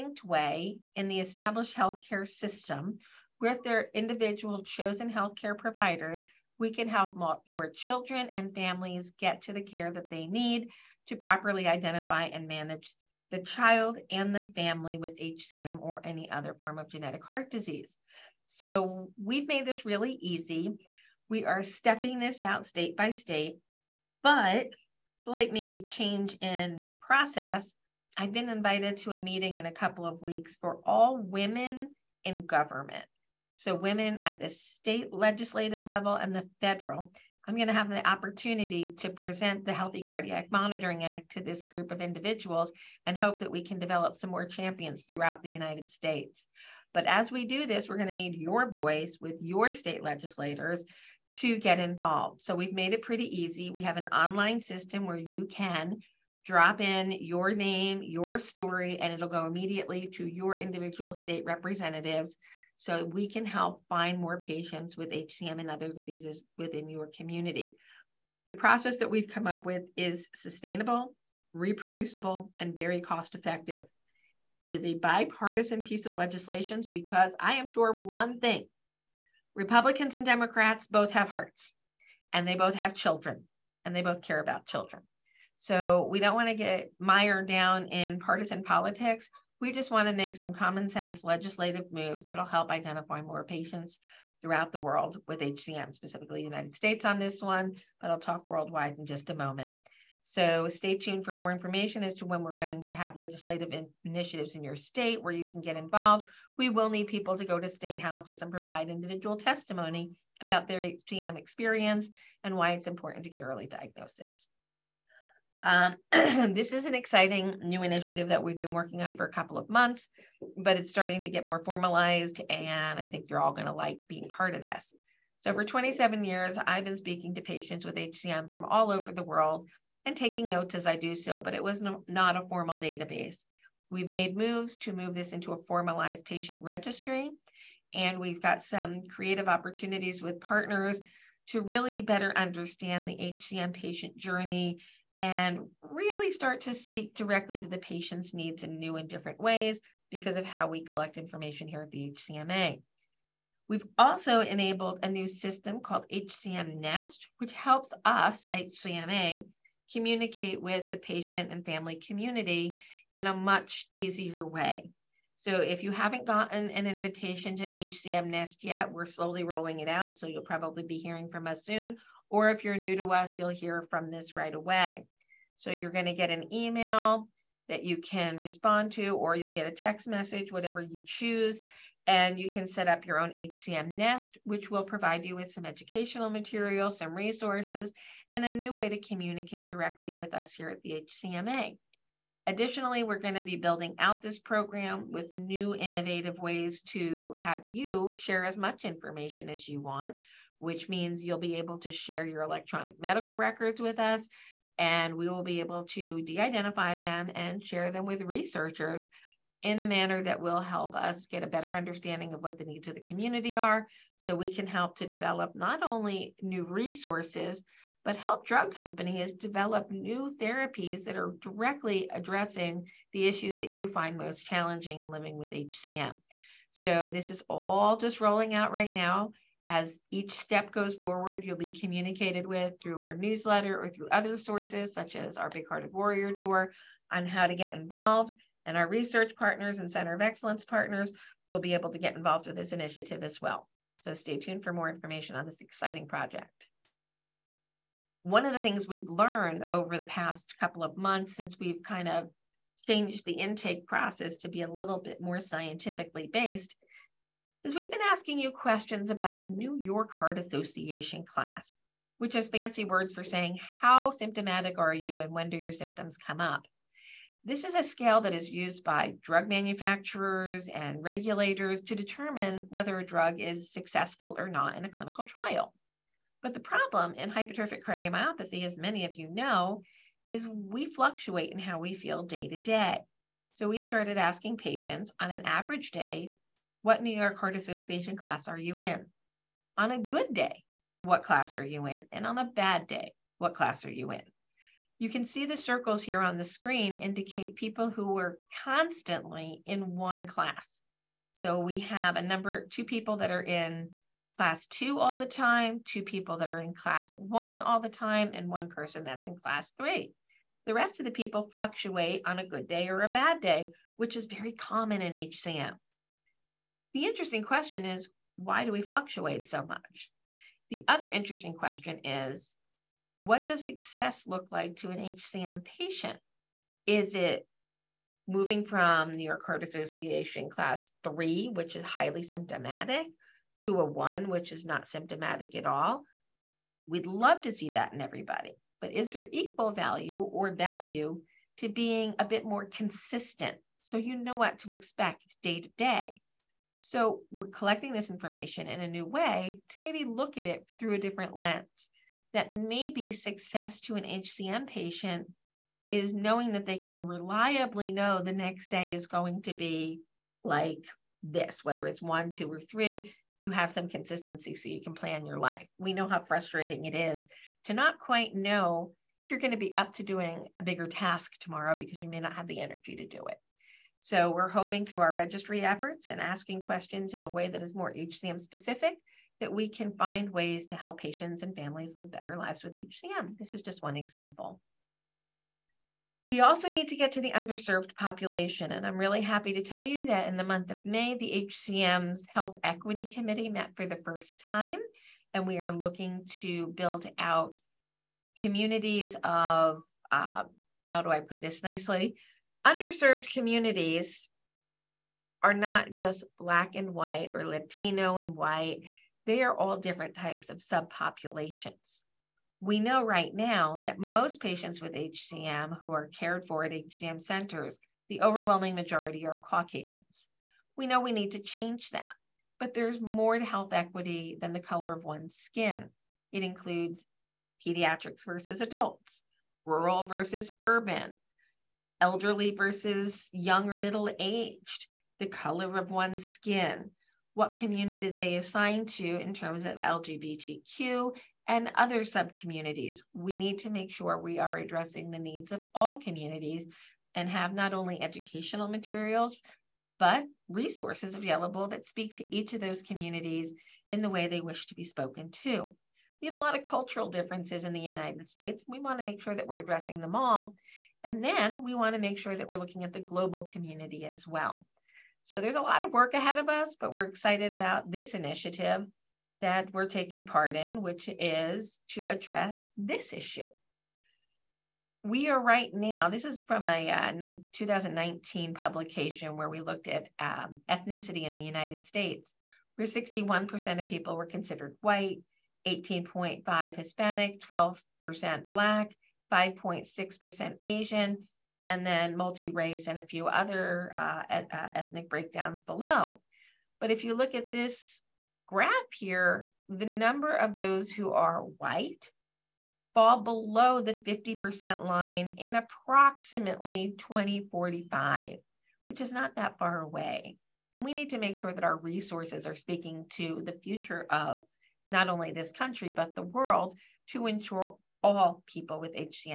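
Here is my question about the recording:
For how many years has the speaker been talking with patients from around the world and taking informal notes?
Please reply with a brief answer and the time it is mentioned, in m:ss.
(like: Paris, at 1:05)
27, at 2:05.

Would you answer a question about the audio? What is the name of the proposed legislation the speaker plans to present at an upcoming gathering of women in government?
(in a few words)
Healthy Cardiac Monitoring Act.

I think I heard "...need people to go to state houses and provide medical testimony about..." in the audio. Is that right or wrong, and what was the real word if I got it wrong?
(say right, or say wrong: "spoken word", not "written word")
wrong: "individual", not "medical".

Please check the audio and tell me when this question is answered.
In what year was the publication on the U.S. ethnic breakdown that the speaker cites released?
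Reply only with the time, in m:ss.
7:57.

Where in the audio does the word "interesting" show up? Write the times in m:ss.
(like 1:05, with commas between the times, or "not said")
5:17, 5:21.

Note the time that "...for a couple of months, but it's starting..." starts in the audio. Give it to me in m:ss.
1:59.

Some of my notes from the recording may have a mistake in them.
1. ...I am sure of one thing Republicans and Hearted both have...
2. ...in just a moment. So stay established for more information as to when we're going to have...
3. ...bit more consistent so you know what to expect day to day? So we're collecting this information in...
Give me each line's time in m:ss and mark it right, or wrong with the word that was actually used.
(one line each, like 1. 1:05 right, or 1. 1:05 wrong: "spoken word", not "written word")
1. 1:17 wrong: "Democrats", not "Hearted"
2. 1:38 wrong: "tuned", not "established"
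3. 5:42 right.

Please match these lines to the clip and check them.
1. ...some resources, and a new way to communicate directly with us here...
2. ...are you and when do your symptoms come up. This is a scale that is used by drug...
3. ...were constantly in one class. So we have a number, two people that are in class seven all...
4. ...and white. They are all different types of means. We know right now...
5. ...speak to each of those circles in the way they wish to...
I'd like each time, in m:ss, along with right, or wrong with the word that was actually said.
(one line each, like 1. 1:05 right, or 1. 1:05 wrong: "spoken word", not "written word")
1. 3:06 right
2. 4:24 right
3. 4:58 wrong: "two", not "seven"
4. 6:48 wrong: "subpopulations", not "means"
5. 7:31 wrong: "communities", not "circles".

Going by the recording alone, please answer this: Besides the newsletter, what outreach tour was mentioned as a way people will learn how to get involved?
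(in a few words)
Big Hearted Warrior Tour.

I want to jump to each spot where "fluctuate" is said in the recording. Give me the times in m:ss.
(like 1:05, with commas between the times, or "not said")
4:40, 5:11, 5:18.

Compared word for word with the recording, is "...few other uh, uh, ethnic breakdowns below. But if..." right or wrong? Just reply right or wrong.
right.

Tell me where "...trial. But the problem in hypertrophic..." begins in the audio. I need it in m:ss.
4:35.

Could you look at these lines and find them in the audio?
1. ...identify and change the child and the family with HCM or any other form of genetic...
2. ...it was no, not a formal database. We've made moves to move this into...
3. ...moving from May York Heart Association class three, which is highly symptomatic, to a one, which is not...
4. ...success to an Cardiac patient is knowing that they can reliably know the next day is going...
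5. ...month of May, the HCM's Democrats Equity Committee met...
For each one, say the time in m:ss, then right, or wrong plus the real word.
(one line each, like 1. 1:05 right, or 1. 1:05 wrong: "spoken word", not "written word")
1. 0:11 wrong: "manage", not "change"
2. 2:11 right
3. 5:28 wrong: "New", not "May"
4. 5:53 wrong: "HCM", not "Cardiac"
5. 6:30 wrong: "Health", not "Democrats".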